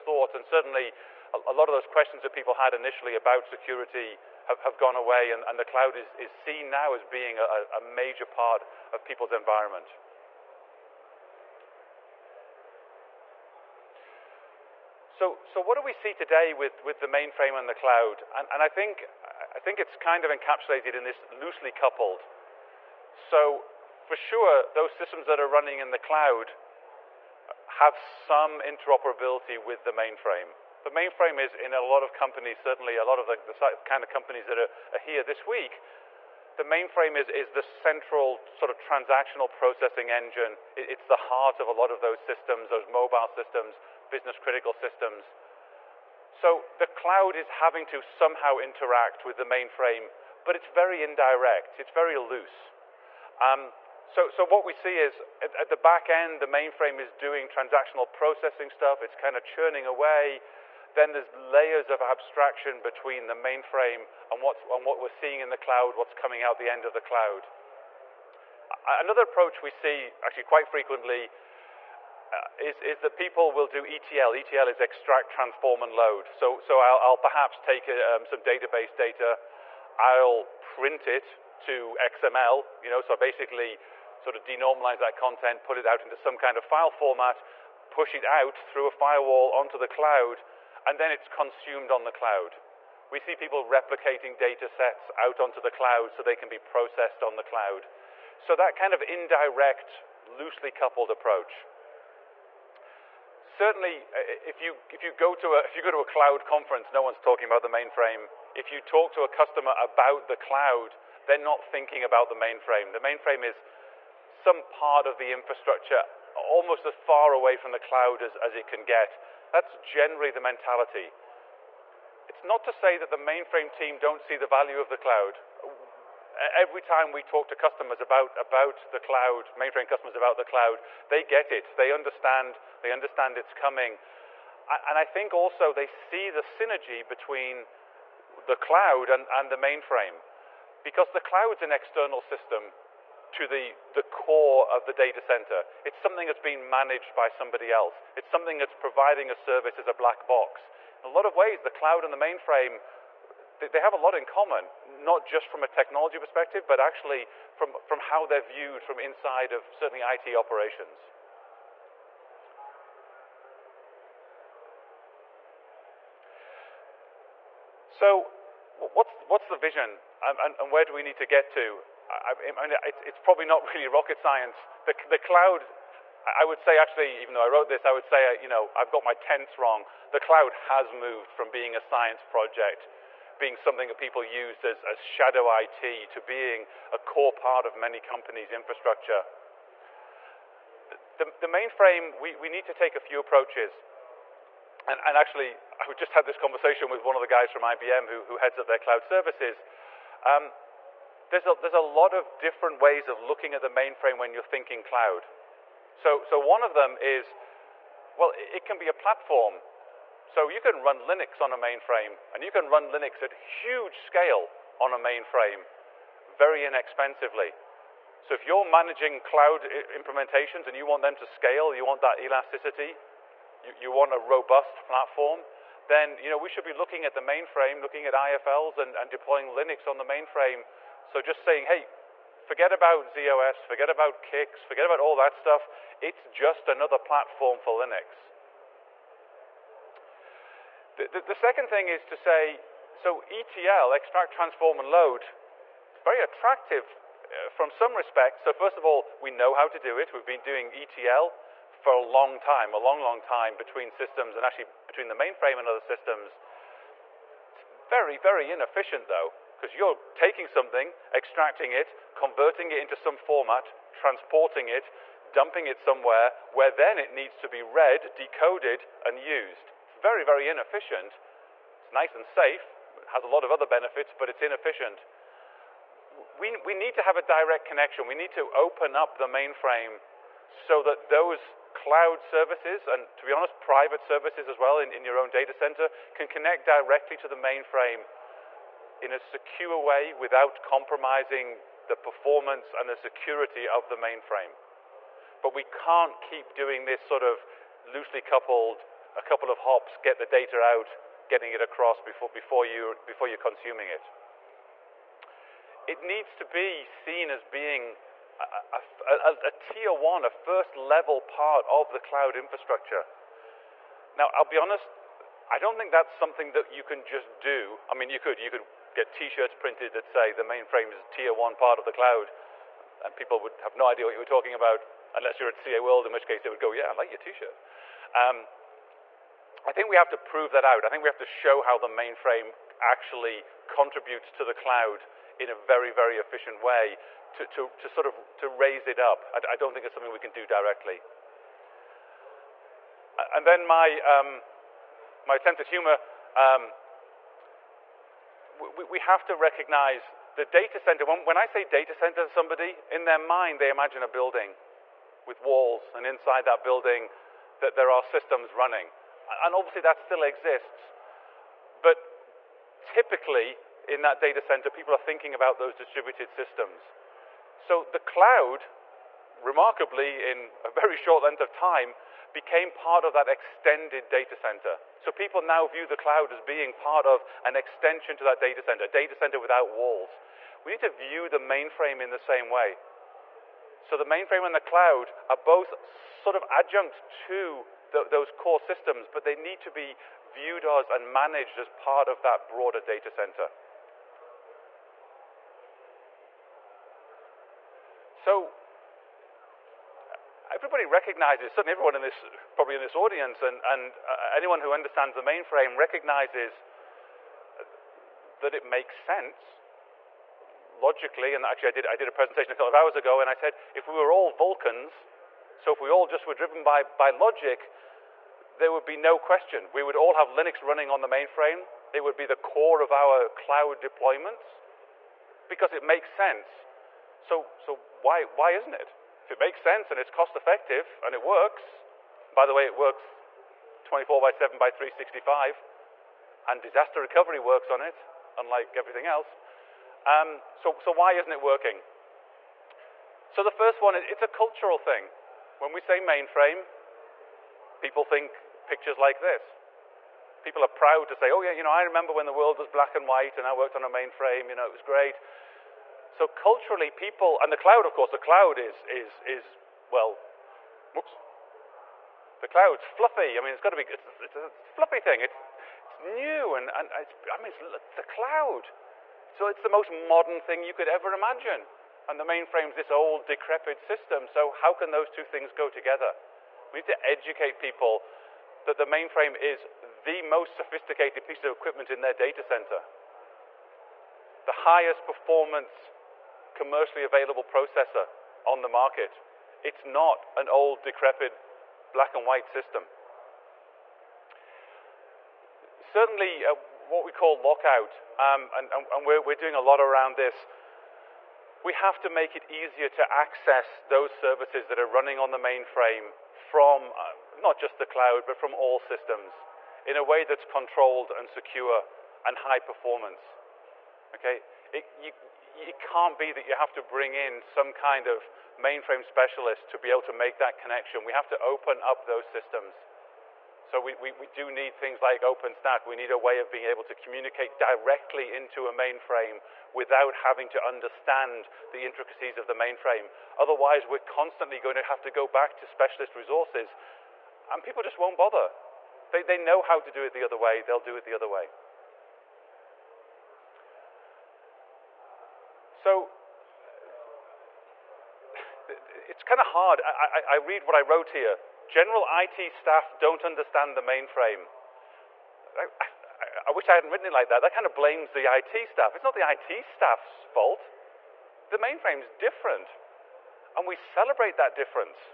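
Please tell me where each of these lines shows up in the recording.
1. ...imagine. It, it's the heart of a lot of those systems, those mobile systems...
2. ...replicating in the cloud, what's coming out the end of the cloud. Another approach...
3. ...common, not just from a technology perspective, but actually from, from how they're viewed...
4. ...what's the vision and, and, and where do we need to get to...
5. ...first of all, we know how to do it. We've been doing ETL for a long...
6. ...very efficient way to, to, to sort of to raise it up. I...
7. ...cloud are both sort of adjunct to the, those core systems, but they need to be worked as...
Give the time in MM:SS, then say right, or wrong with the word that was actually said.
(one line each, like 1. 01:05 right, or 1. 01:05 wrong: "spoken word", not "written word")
1. 00:40 wrong: "engine", not "imagine"
2. 01:05 wrong: "seeing", not "replicating"
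3. 02:34 right
4. 02:49 right
5. 04:08 right
6. 05:35 right
7. 06:24 wrong: "viewed", not "worked".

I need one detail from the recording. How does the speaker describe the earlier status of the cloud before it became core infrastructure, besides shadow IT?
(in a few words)
A science project.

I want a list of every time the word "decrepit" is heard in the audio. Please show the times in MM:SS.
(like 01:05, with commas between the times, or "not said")
07:53, 08:10.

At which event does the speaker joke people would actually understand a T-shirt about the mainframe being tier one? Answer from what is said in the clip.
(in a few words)
CA World.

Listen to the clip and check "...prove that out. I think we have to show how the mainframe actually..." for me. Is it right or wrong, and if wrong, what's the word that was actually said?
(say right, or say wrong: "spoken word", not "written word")
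right.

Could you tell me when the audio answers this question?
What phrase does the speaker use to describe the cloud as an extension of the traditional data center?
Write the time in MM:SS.
06:18.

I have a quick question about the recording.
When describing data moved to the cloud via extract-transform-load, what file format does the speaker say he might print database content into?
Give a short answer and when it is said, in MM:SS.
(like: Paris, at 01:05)
XML, at 01:22.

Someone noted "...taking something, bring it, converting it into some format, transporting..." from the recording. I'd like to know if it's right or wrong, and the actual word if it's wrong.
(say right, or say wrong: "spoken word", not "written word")
wrong: "extracting", not "bring".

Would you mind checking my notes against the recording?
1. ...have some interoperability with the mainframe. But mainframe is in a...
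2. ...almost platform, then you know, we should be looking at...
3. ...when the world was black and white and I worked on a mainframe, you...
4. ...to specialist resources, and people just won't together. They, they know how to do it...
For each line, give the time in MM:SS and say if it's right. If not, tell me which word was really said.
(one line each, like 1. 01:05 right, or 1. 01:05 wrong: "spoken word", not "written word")
1. 00:27 right
2. 03:44 wrong: "robust", not "almost"
3. 07:32 right
4. 08:55 wrong: "bother", not "together".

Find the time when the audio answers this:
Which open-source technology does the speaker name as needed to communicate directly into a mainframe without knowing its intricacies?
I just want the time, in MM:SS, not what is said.
08:45.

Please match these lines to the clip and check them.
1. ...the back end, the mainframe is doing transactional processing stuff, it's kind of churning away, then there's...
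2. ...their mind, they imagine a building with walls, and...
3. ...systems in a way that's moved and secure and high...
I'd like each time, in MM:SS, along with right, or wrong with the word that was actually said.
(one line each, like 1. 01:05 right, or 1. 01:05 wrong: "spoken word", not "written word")
1. 00:55 right
2. 05:53 right
3. 08:28 wrong: "controlled", not "moved".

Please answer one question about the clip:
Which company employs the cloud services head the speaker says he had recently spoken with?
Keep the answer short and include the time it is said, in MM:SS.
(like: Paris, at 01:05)
IBM, at 03:17.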